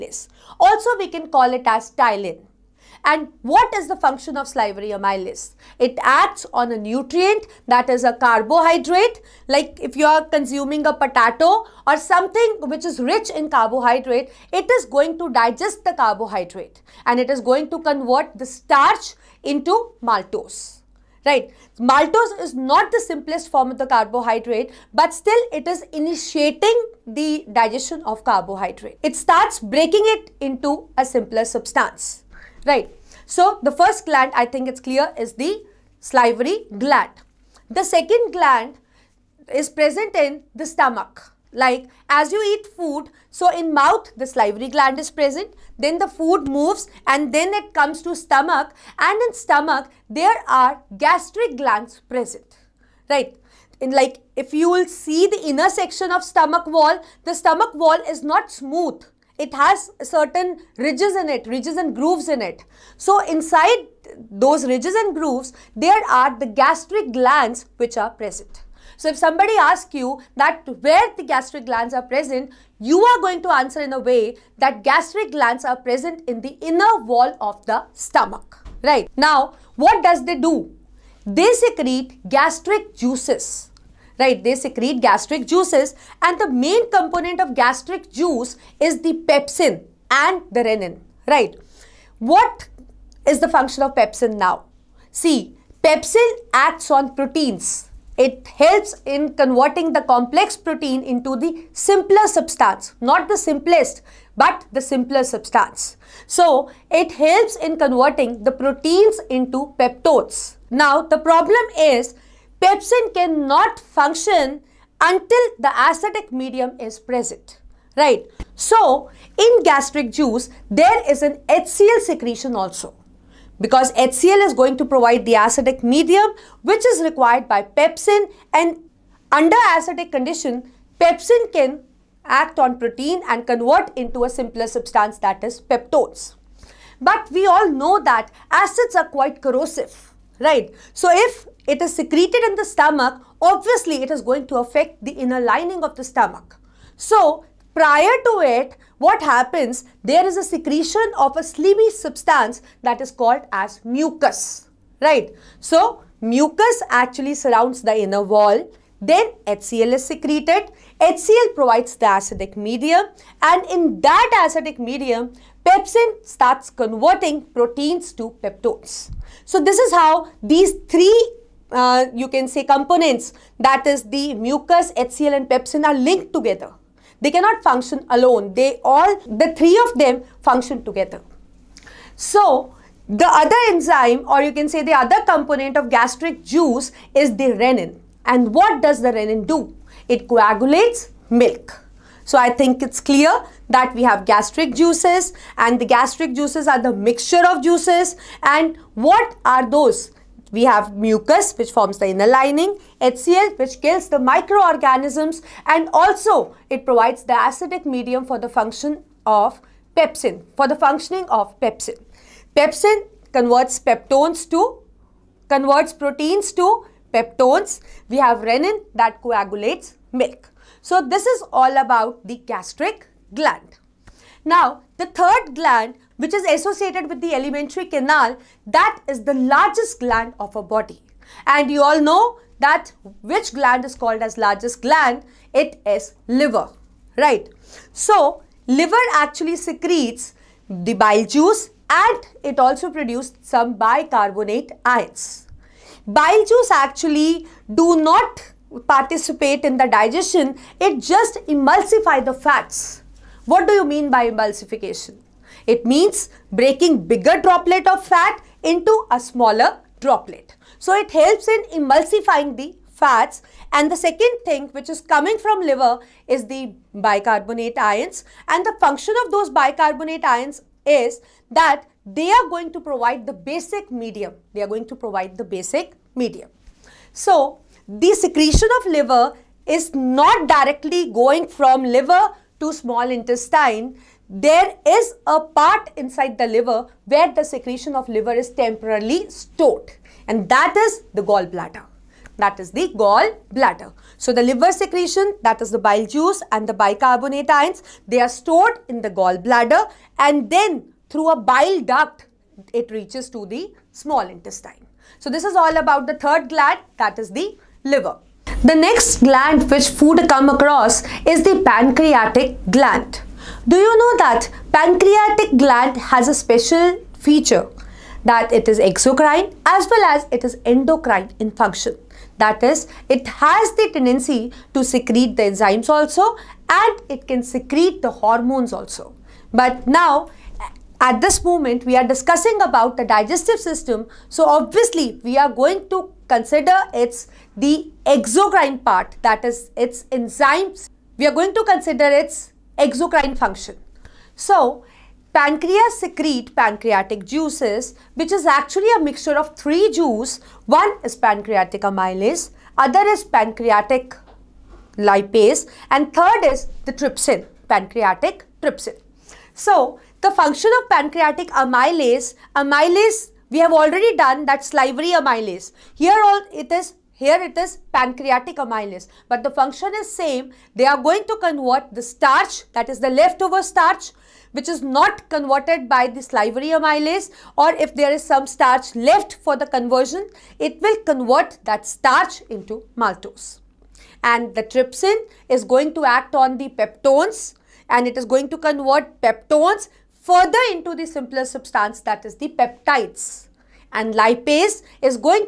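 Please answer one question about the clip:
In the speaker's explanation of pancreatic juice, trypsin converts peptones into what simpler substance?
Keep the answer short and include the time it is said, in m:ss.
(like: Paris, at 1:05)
Peptides, at 6:32.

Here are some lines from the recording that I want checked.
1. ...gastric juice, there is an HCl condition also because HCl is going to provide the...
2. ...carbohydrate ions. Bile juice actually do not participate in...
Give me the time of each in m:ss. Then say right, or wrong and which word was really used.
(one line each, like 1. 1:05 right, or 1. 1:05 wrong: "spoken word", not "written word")
1. 1:59 wrong: "secretion", not "condition"
2. 4:03 wrong: "bicarbonate", not "carbohydrate".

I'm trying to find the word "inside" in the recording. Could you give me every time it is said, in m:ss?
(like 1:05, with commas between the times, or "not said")
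1:03, 4:45.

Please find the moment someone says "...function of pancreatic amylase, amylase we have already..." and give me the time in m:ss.
6:00.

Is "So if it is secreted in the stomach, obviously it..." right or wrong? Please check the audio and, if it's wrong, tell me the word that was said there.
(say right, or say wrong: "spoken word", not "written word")
right.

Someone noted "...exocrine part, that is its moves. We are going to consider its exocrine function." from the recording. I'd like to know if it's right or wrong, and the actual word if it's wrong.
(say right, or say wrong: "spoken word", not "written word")
wrong: "enzymes", not "moves".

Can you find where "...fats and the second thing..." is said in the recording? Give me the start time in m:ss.
4:22.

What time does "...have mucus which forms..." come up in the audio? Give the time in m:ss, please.
3:20.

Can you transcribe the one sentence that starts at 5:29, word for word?
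But now, at this moment, we are discussing about the digestive system.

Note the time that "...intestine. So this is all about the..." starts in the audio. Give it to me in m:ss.
5:04.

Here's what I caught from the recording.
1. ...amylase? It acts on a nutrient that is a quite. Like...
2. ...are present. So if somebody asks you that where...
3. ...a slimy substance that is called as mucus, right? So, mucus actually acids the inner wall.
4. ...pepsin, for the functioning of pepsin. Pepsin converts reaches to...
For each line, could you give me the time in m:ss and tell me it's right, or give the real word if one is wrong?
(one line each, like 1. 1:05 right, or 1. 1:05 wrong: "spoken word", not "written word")
1. 0:04 wrong: "carbohydrate", not "quite"
2. 1:07 right
3. 2:31 wrong: "surrounds", not "acids"
4. 3:29 wrong: "peptones", not "reaches".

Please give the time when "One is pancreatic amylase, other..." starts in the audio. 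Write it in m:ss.
5:50.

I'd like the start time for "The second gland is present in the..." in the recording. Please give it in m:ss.
0:37.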